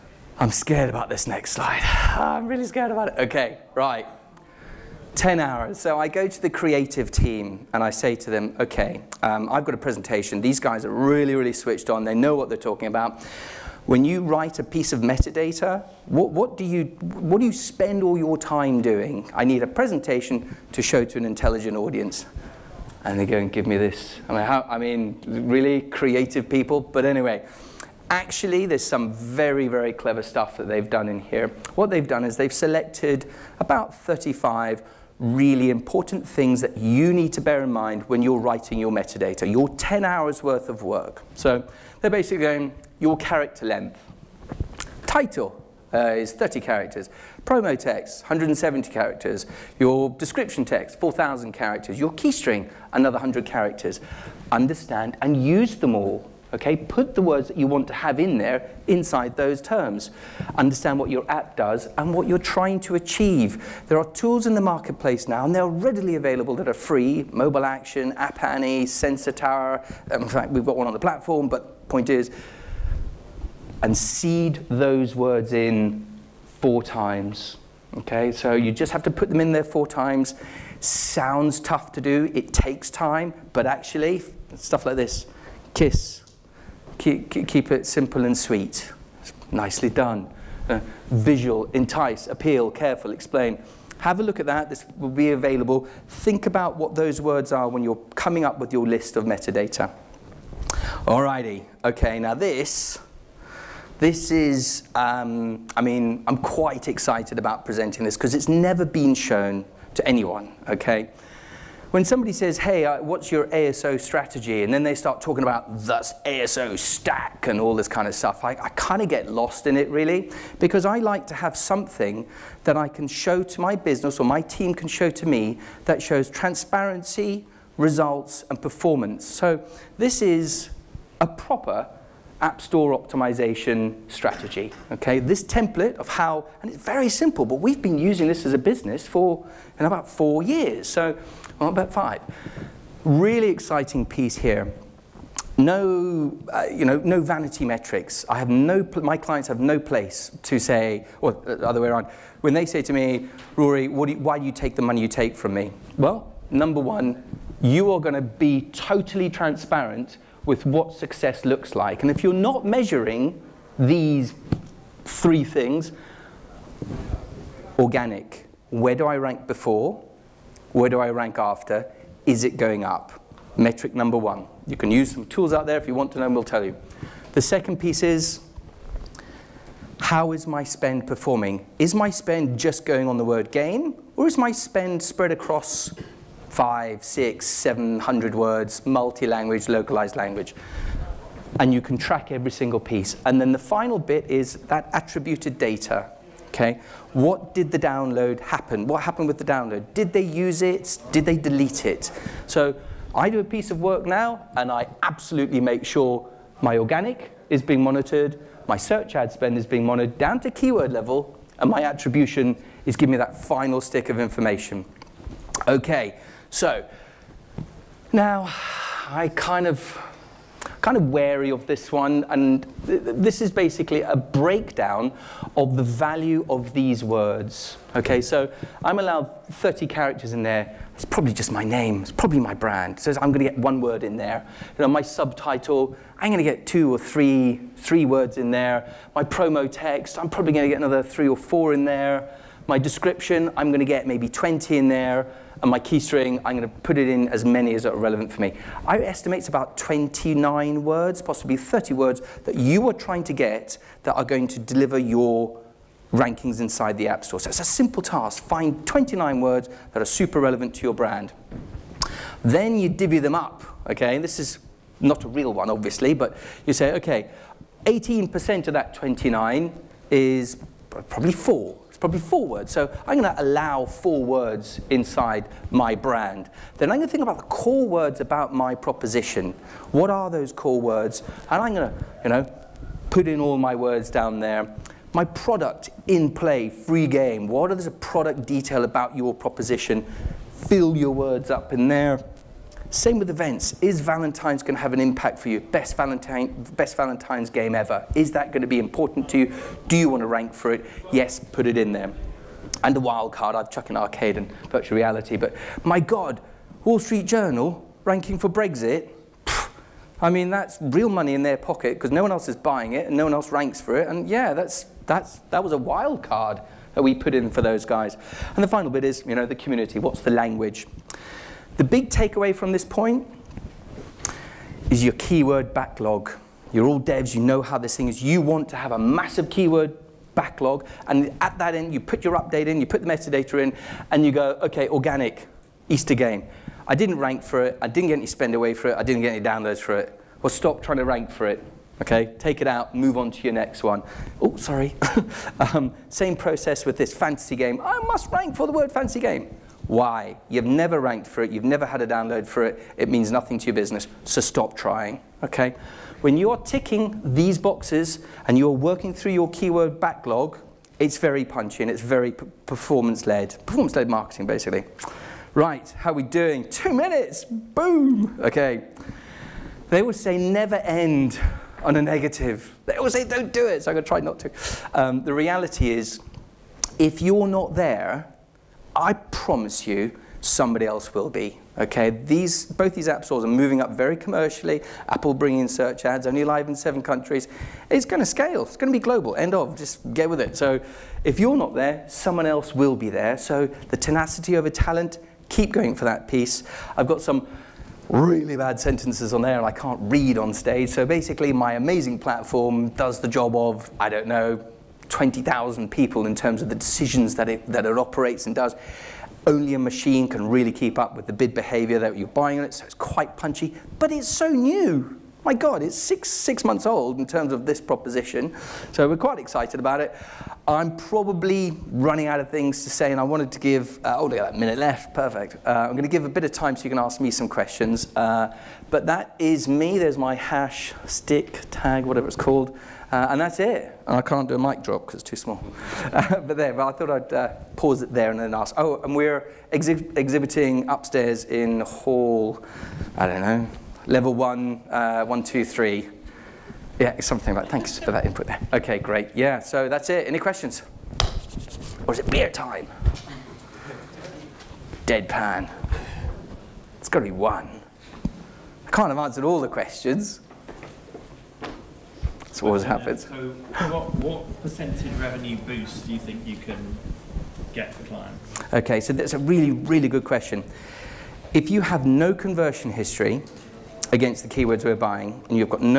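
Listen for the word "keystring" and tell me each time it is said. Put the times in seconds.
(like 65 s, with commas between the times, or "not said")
52 s, 245 s.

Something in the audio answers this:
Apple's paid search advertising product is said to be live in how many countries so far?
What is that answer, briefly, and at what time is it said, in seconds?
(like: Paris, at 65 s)
7, at 386 s.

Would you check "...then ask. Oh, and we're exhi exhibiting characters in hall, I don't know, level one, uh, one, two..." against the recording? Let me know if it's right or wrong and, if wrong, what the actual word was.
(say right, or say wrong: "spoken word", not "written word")
wrong: "upstairs", not "characters".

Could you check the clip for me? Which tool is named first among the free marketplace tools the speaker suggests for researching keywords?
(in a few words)
Mobile Action.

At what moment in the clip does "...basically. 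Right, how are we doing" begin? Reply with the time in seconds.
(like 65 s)
364 s.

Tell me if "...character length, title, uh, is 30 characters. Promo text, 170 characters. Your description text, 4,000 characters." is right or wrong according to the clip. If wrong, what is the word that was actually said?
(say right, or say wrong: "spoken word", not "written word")
right.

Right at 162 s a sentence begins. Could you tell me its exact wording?
And if you're not measuring these three things organic, where do I rank before?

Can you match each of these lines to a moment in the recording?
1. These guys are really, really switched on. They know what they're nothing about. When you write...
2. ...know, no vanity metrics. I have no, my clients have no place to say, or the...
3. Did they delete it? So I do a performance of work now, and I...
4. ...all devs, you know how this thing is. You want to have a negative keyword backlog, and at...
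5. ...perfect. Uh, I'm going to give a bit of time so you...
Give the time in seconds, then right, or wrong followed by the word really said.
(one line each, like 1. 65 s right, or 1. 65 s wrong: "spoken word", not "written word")
1. 10 s wrong: "talking", not "nothing"
2. 146 s right
3. 201 s wrong: "piece", not "performance"
4. 326 s wrong: "massive", not "negative"
5. 425 s right.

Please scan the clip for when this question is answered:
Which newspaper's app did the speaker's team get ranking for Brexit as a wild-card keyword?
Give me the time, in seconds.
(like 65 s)
306 s.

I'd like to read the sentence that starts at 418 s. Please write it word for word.
So we're quite excited about it.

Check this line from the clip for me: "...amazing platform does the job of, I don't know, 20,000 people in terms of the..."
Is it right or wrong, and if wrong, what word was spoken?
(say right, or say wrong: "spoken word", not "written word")
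right.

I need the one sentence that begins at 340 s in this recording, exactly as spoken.
Well, stop trying to rank for it.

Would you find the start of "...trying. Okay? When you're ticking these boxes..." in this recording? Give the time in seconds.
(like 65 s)
354 s.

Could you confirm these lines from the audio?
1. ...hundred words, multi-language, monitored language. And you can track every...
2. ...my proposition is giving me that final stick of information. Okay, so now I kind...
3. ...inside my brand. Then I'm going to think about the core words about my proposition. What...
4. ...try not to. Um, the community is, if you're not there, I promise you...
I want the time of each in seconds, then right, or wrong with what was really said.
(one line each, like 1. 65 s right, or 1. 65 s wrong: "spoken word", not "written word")
1. 187 s wrong: "localized", not "monitored"
2. 211 s wrong: "attribution", not "proposition"
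3. 274 s right
4. 374 s wrong: "reality", not "community".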